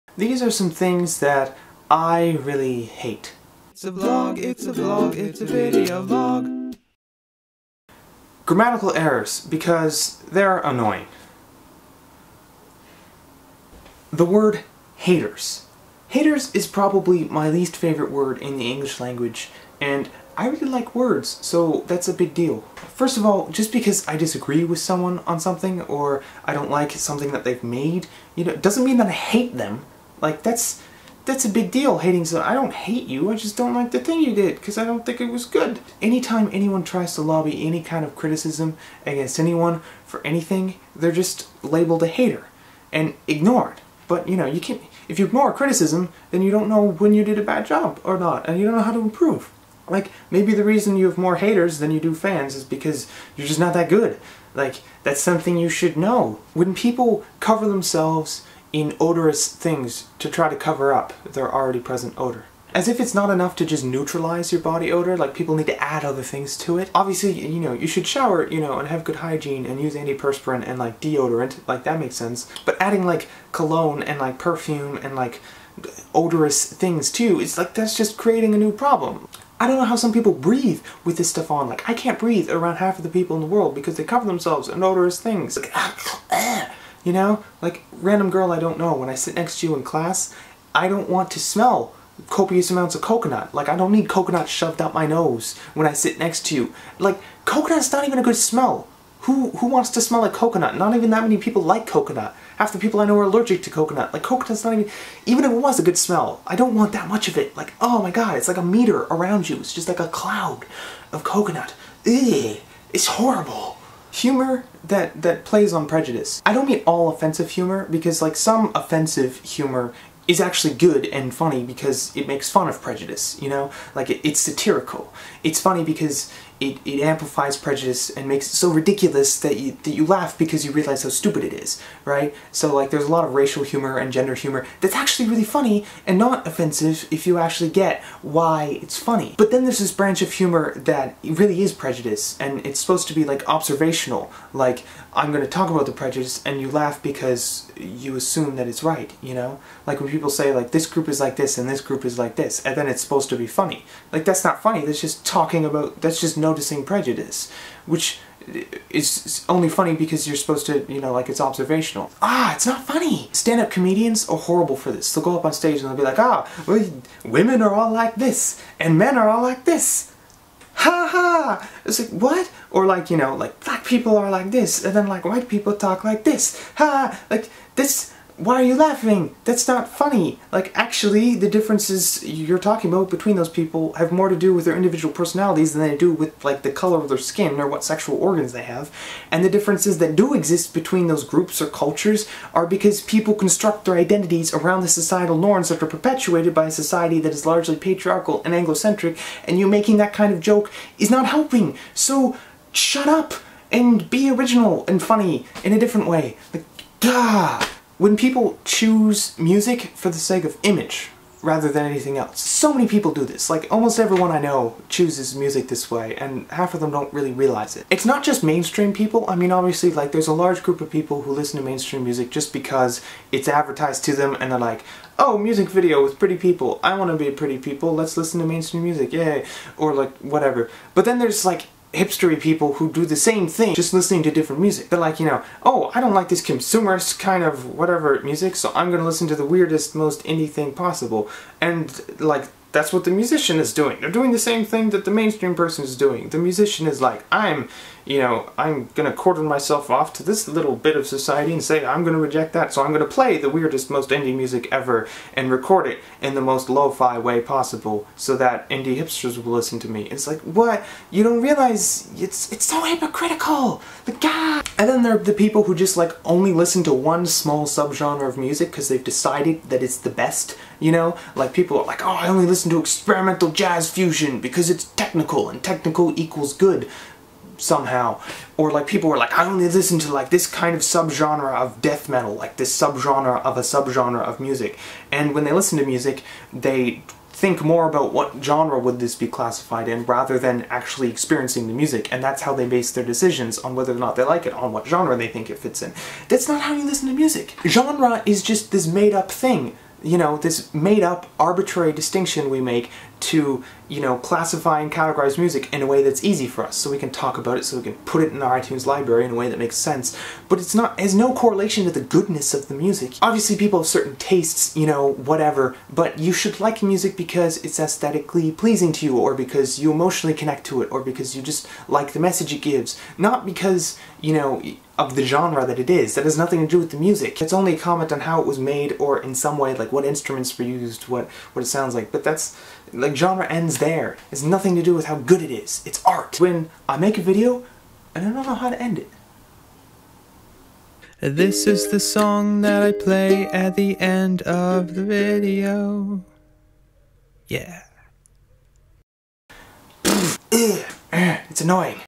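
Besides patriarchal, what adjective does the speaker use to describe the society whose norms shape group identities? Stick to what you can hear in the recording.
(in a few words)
Anglocentric.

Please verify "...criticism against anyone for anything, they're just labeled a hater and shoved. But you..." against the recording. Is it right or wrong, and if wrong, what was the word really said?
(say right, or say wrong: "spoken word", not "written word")
wrong: "ignored", not "shoved".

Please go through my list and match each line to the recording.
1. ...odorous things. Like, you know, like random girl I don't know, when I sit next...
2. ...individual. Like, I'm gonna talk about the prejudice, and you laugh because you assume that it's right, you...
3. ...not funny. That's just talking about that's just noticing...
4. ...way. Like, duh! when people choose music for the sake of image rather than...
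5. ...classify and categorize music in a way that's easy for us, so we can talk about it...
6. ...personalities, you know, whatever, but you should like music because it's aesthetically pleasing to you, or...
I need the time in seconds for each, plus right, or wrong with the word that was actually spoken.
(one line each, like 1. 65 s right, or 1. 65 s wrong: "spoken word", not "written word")
1. 84 s right
2. 143 s wrong: "observational", not "individual"
3. 154 s right
4. 206 s right
5. 304 s right
6. 314 s wrong: "tastes", not "personalities".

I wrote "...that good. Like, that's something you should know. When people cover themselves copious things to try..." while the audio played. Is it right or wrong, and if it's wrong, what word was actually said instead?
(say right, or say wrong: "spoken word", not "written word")
wrong: "inodorous", not "copious".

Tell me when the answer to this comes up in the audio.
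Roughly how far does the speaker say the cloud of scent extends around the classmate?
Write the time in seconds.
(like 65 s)
108 s.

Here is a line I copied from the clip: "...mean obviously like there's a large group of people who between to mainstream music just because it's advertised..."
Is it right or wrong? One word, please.
wrong.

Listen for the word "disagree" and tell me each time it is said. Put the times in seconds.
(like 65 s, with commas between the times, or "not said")
24 s.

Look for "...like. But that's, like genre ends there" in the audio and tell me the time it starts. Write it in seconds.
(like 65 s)
331 s.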